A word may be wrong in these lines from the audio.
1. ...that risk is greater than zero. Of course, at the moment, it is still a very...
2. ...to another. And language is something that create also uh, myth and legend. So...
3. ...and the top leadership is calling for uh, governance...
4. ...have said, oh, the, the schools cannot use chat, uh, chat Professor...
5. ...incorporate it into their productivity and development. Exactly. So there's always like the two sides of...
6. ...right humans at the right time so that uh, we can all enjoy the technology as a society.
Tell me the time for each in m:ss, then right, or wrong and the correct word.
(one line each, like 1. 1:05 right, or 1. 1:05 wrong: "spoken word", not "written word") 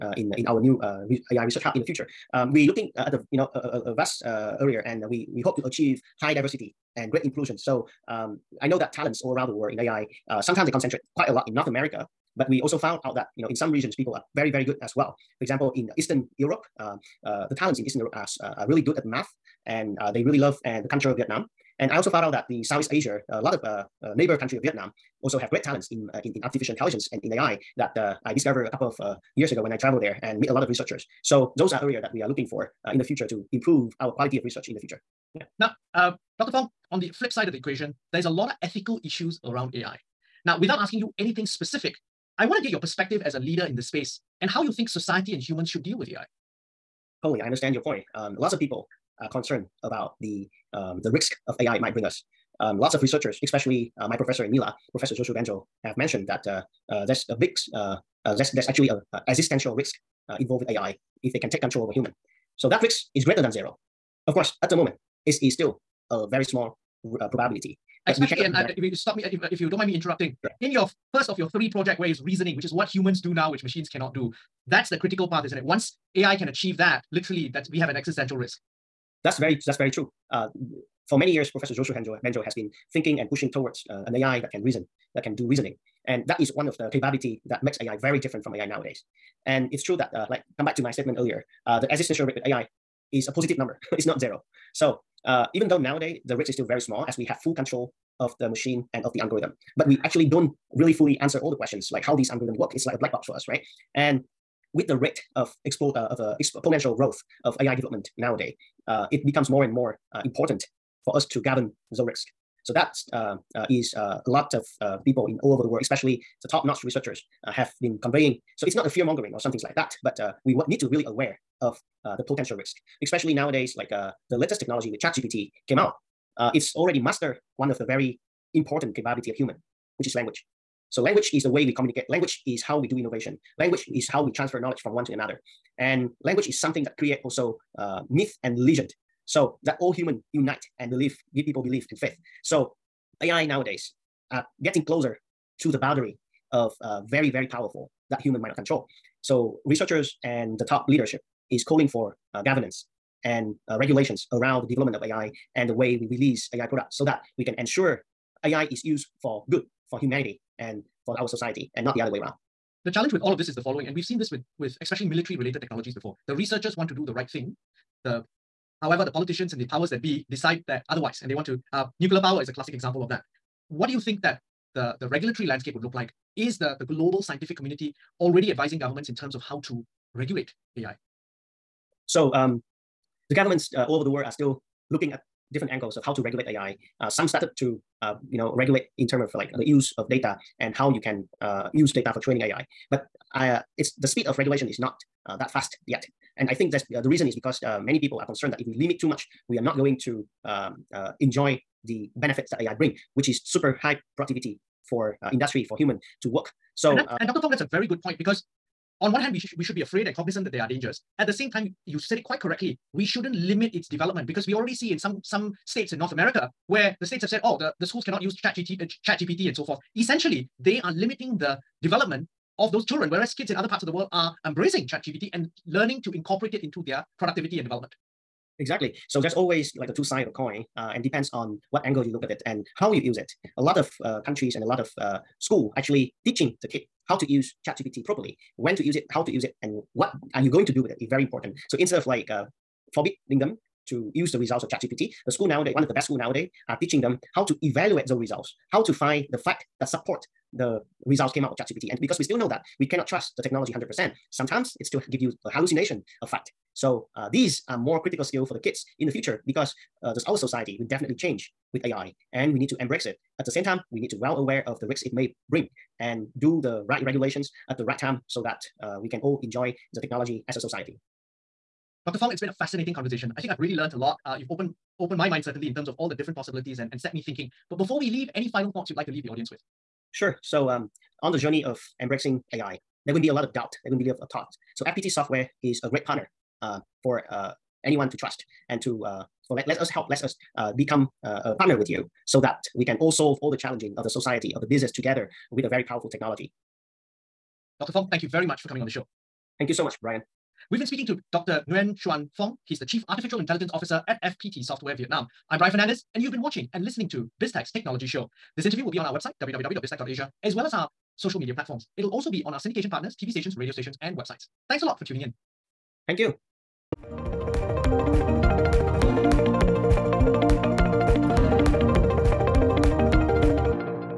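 1. 1:02 right
2. 2:15 right
3. 2:30 right
4. 3:37 wrong: "GPT", not "Professor"
5. 3:46 right
6. 4:26 wrong: "regulations", not "humans".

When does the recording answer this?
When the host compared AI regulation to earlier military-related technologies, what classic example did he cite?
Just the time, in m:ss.
2:52.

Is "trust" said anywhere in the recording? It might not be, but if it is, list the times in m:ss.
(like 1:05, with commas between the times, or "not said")
4:13, 4:48.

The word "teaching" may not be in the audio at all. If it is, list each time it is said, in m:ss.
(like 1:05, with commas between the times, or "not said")
3:56, 4:06.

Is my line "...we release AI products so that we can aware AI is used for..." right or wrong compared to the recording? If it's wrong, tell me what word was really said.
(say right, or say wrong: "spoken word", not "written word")
wrong: "ensure", not "aware".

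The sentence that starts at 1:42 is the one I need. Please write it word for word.
It's like a black box for us, right?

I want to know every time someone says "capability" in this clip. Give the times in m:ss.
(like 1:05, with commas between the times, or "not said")
1:26, 2:08.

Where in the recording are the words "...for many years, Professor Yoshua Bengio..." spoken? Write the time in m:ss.
1:21.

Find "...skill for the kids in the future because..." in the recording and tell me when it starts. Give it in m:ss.
4:18.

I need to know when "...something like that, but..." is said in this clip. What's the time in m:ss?
1:59.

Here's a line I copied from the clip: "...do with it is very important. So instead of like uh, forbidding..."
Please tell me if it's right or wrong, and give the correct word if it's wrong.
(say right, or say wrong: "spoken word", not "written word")
right.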